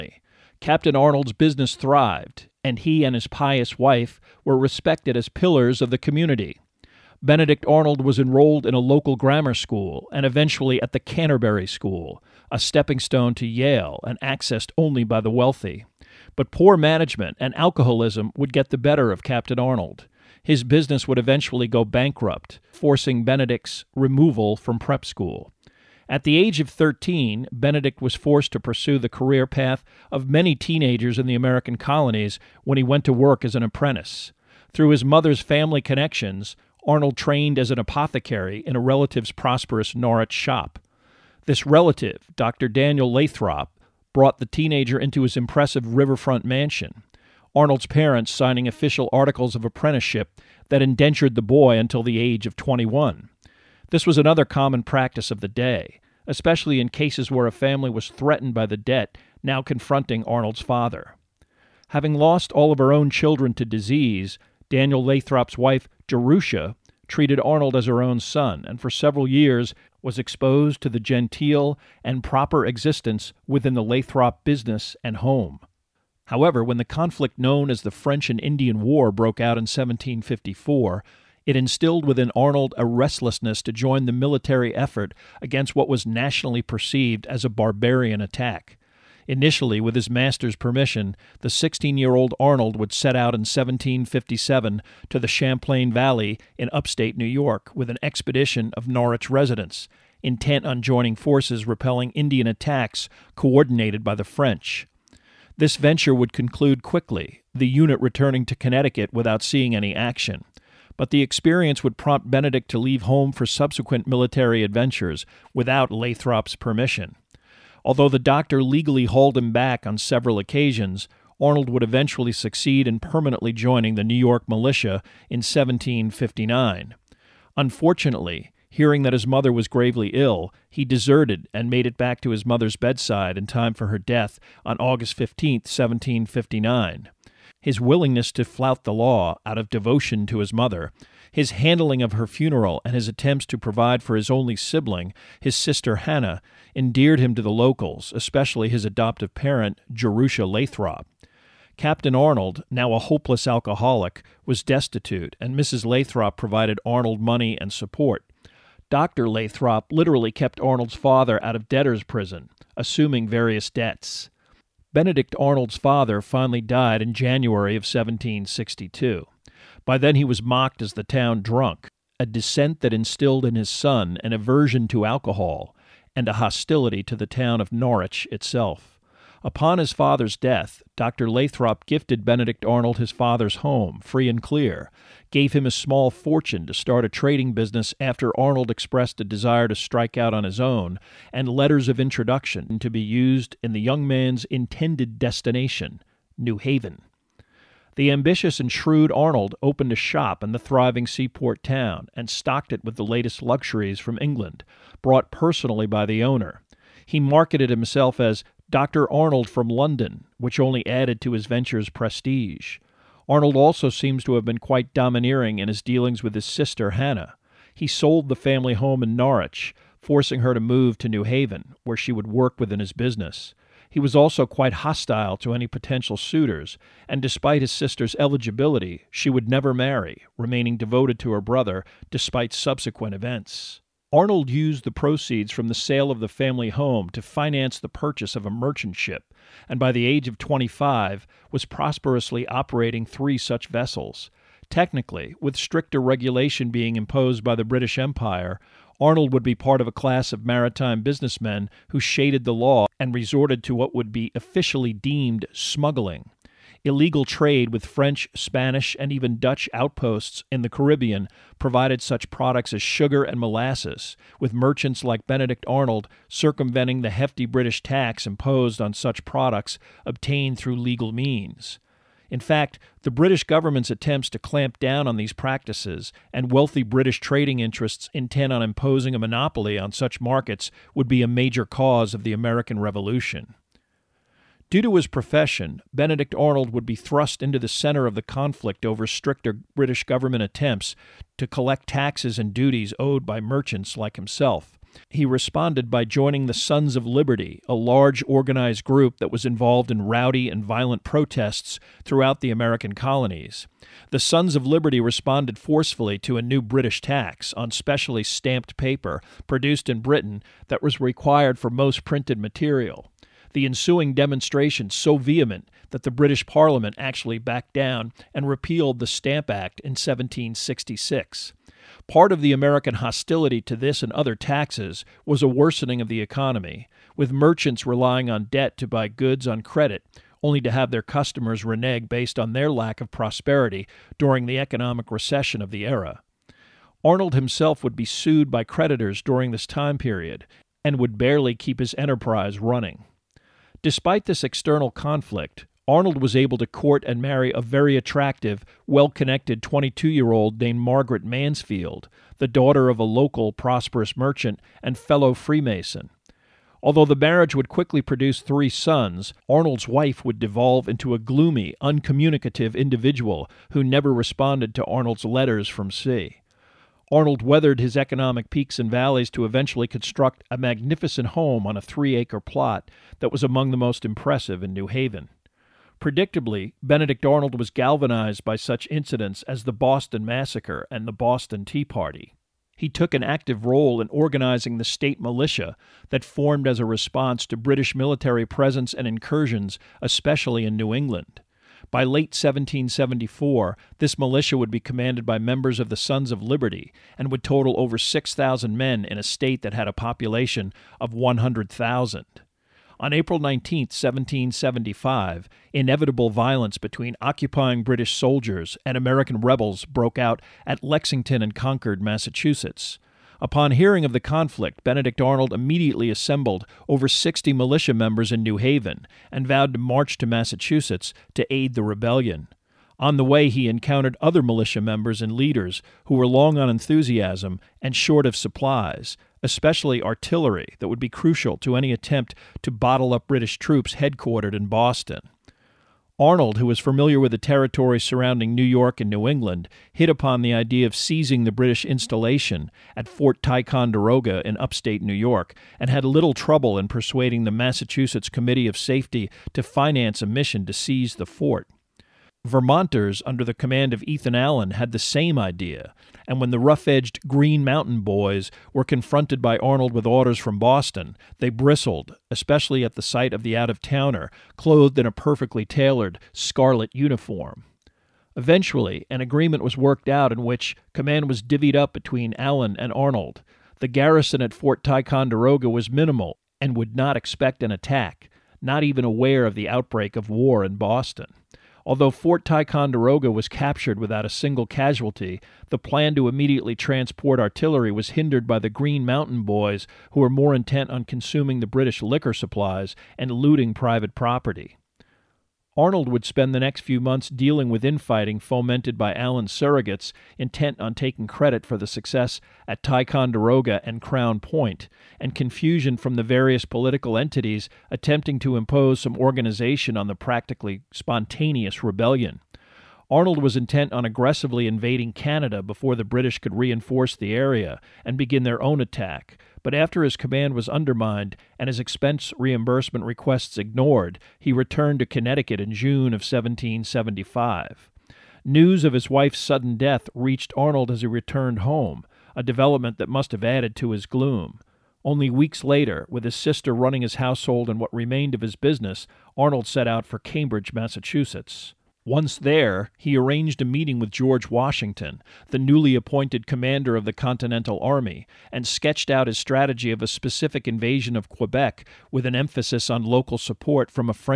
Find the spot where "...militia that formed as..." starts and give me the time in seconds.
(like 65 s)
385 s.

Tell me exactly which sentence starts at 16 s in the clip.
But poor management and alcoholism would get the better of Captain Arnold.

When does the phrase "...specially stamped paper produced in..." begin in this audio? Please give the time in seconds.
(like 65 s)
307 s.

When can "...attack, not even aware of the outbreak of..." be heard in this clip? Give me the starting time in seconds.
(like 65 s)
477 s.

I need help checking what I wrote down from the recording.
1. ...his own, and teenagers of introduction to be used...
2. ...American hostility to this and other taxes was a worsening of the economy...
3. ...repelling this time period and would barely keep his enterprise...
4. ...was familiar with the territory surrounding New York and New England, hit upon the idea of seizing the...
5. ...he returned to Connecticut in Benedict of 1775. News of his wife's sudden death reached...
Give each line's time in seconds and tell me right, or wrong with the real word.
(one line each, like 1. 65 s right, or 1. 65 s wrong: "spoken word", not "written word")
1. 190 s wrong: "letters", not "teenagers"
2. 322 s right
3. 339 s wrong: "during", not "repelling"
4. 436 s right
5. 524 s wrong: "June", not "Benedict".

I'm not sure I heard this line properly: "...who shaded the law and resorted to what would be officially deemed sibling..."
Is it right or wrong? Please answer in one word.
wrong.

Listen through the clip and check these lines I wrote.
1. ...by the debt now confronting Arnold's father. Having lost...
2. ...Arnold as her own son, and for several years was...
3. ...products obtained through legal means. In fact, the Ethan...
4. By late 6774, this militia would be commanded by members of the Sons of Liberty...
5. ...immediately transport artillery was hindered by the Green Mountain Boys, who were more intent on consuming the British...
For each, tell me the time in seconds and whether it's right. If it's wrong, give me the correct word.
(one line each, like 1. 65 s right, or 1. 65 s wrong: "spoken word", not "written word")
1. 58 s right
2. 67 s right
3. 269 s wrong: "British", not "Ethan"
4. 391 s wrong: "1774", not "6774"
5. 486 s right.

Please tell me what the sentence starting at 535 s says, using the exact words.
Only weeks later, with his sister running his household and what remained of his business, Arnold set out for Cambridge, Massachusetts.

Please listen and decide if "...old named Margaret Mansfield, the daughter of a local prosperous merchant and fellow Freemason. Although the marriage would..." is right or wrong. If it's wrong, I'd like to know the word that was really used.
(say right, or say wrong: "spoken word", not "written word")
right.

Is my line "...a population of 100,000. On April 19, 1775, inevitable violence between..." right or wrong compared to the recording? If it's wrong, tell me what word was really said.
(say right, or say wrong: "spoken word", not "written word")
right.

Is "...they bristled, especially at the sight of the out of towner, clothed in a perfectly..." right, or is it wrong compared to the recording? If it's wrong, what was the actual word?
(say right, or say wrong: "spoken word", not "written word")
right.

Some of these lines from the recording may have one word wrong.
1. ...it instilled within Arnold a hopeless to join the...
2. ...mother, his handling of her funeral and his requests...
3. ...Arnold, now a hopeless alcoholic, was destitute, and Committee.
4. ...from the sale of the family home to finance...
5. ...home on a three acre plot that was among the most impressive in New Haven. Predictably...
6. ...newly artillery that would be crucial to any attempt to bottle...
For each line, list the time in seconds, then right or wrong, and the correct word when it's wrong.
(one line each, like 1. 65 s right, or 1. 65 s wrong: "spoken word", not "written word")
1. 81 s wrong: "restlessness", not "hopeless"
2. 140 s wrong: "attempts", not "requests"
3. 152 s wrong: "Mrs", not "Committee"
4. 235 s right
5. 371 s right
6. 429 s wrong: "especially", not "newly".